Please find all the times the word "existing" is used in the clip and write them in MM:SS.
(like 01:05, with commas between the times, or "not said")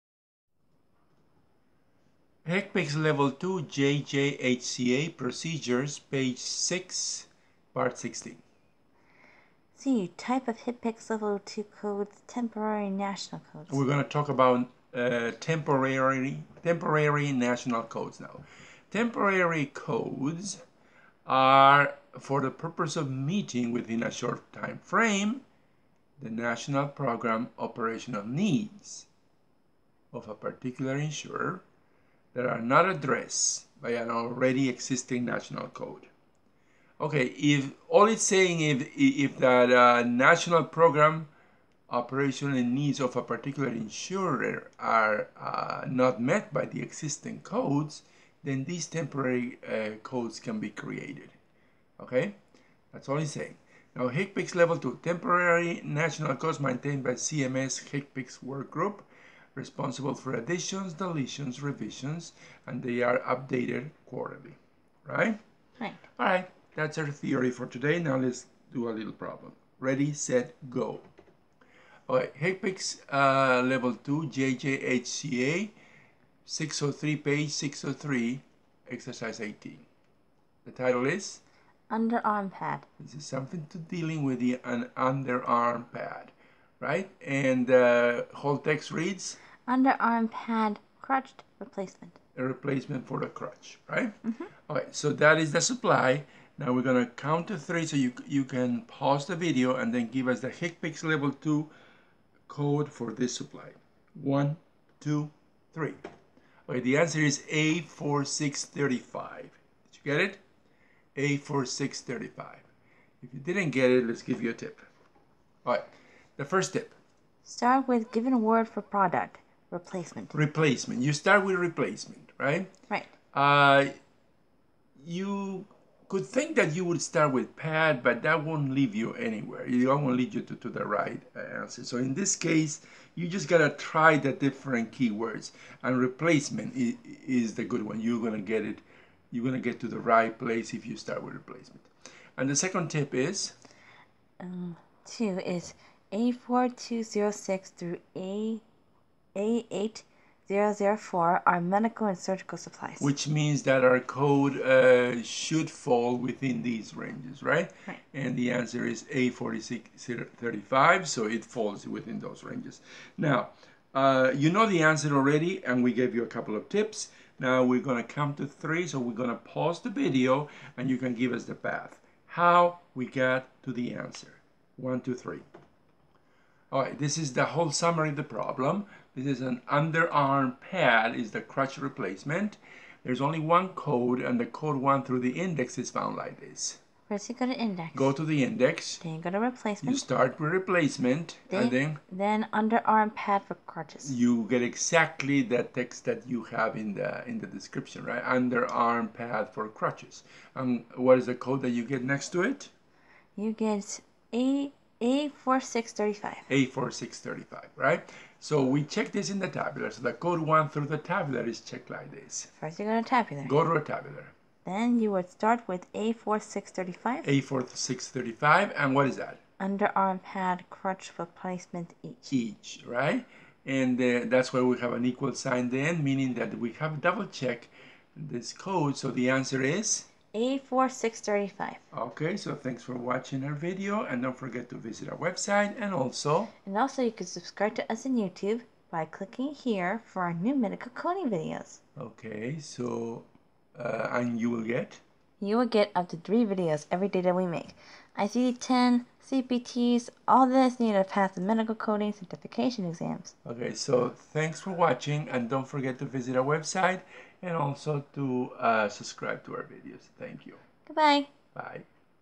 00:34, 00:46.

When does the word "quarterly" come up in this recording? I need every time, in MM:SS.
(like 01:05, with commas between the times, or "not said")
01:04.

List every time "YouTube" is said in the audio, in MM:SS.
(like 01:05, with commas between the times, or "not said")
03:58.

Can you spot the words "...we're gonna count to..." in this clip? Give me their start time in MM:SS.
01:36.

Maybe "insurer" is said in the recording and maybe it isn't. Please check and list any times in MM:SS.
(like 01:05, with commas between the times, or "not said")
00:30, 00:43.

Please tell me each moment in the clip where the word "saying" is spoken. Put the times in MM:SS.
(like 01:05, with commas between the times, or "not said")
00:38, 00:53.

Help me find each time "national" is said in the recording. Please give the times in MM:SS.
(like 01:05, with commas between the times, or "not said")
00:12, 00:17, 00:26, 00:35, 00:40, 00:55.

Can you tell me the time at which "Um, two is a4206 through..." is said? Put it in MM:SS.
02:24.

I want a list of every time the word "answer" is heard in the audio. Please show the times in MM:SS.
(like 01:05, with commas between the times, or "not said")
01:46, 02:11, 02:38, 02:44, 02:53, 03:49.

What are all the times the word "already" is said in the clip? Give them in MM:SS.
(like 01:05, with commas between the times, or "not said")
00:34, 02:45.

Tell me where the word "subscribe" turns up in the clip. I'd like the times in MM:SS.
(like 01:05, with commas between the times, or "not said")
03:57, 04:18.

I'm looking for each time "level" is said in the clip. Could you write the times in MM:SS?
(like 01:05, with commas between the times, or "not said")
00:03, 00:11, 00:54, 01:13, 01:41.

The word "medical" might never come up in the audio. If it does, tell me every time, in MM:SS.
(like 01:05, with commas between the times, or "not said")
02:31, 04:00, 04:11.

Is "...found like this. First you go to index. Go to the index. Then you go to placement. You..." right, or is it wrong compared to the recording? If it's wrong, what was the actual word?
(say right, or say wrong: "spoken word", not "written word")
wrong: "replacement", not "placement".